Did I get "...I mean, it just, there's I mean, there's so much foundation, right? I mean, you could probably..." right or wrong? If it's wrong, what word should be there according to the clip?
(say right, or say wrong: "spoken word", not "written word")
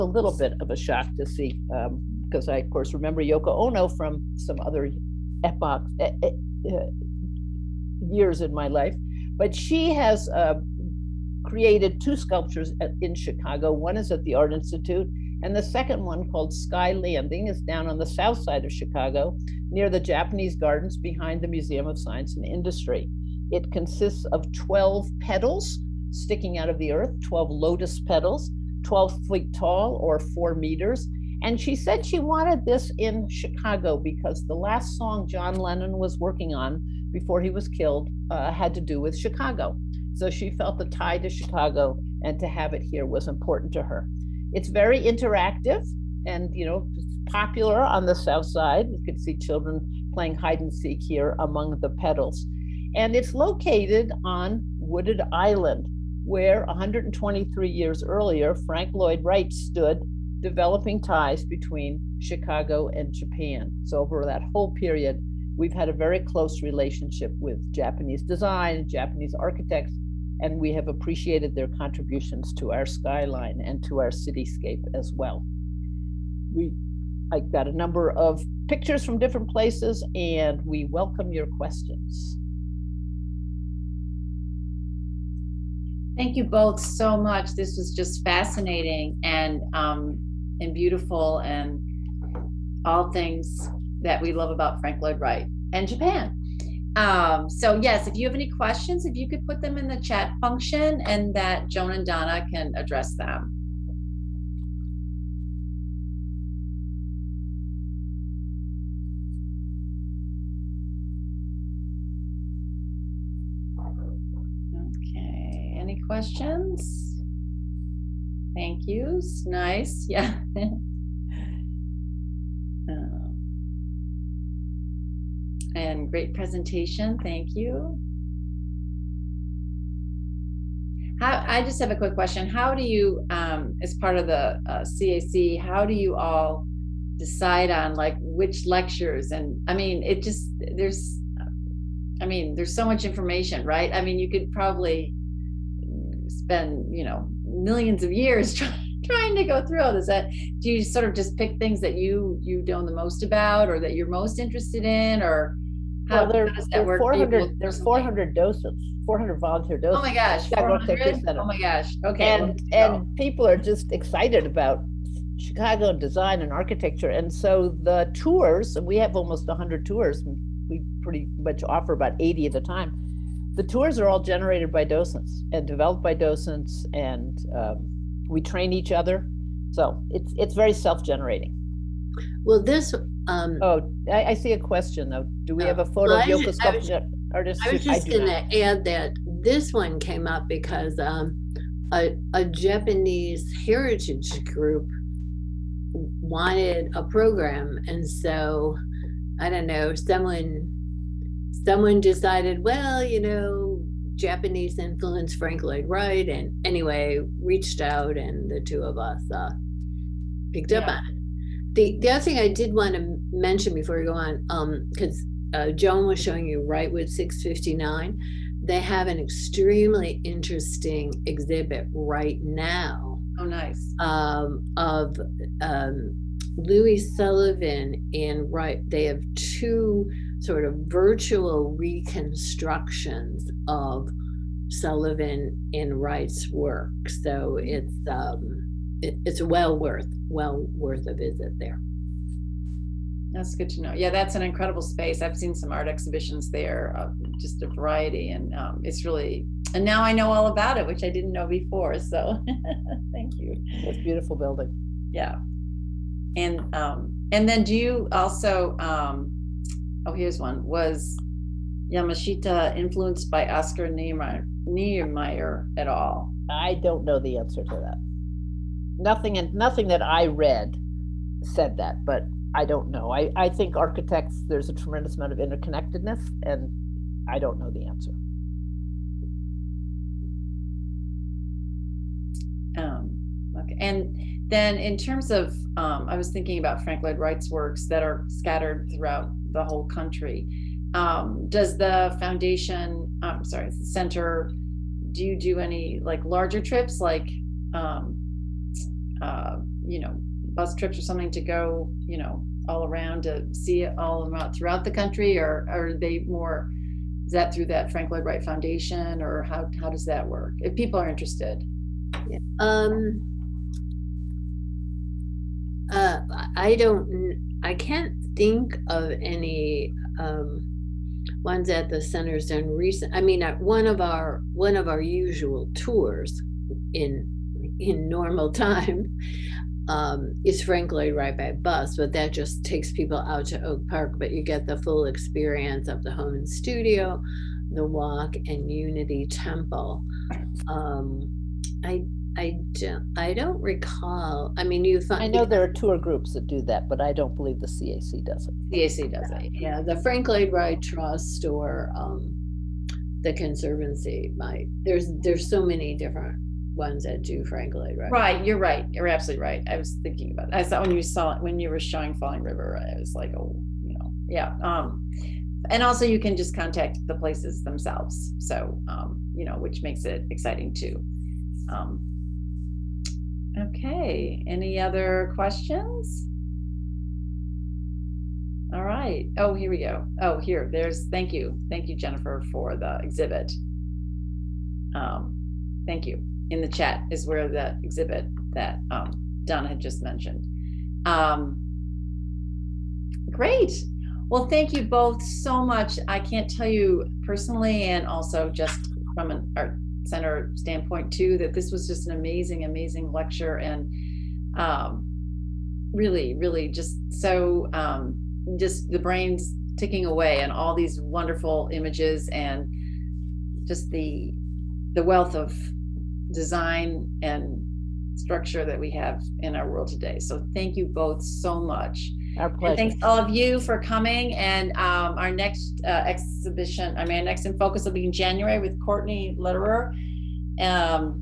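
wrong: "information", not "foundation".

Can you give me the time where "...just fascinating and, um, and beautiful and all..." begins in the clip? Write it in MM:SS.
01:27.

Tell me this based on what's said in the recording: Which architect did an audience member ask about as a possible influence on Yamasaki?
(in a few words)
Oscar Niemeyer.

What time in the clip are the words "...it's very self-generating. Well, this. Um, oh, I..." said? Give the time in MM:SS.
03:00.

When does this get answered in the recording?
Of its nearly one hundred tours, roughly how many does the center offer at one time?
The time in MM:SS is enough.
02:51.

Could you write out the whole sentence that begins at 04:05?
I've seen some art exhibitions there, uh, just a variety, and um, it's really.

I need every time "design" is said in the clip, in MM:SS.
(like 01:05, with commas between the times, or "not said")
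01:08, 02:45, 06:56.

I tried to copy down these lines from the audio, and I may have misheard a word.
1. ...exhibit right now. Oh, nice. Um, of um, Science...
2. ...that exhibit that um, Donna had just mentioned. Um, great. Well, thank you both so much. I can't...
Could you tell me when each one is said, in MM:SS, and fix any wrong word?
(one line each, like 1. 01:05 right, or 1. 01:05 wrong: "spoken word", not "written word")
1. 03:41 wrong: "Louis", not "Science"
2. 06:27 right.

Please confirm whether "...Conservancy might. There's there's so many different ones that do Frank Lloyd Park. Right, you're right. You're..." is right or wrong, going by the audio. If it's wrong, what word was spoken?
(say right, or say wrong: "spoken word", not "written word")
wrong: "Wright", not "Park".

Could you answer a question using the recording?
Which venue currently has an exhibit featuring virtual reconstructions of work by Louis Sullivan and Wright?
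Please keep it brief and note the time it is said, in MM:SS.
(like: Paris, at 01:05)
Wrightwood 659, at 03:36.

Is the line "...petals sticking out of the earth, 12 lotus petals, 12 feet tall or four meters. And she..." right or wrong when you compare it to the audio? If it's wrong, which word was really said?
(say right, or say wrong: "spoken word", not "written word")
right.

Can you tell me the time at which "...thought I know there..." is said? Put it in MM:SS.
05:45.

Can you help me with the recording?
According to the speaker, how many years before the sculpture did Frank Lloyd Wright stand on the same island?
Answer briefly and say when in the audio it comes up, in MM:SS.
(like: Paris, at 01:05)
123, at 00:56.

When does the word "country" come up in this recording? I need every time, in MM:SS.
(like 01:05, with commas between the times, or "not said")
04:49, 05:04.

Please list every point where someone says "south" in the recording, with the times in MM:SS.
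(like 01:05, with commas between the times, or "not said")
00:18, 00:48.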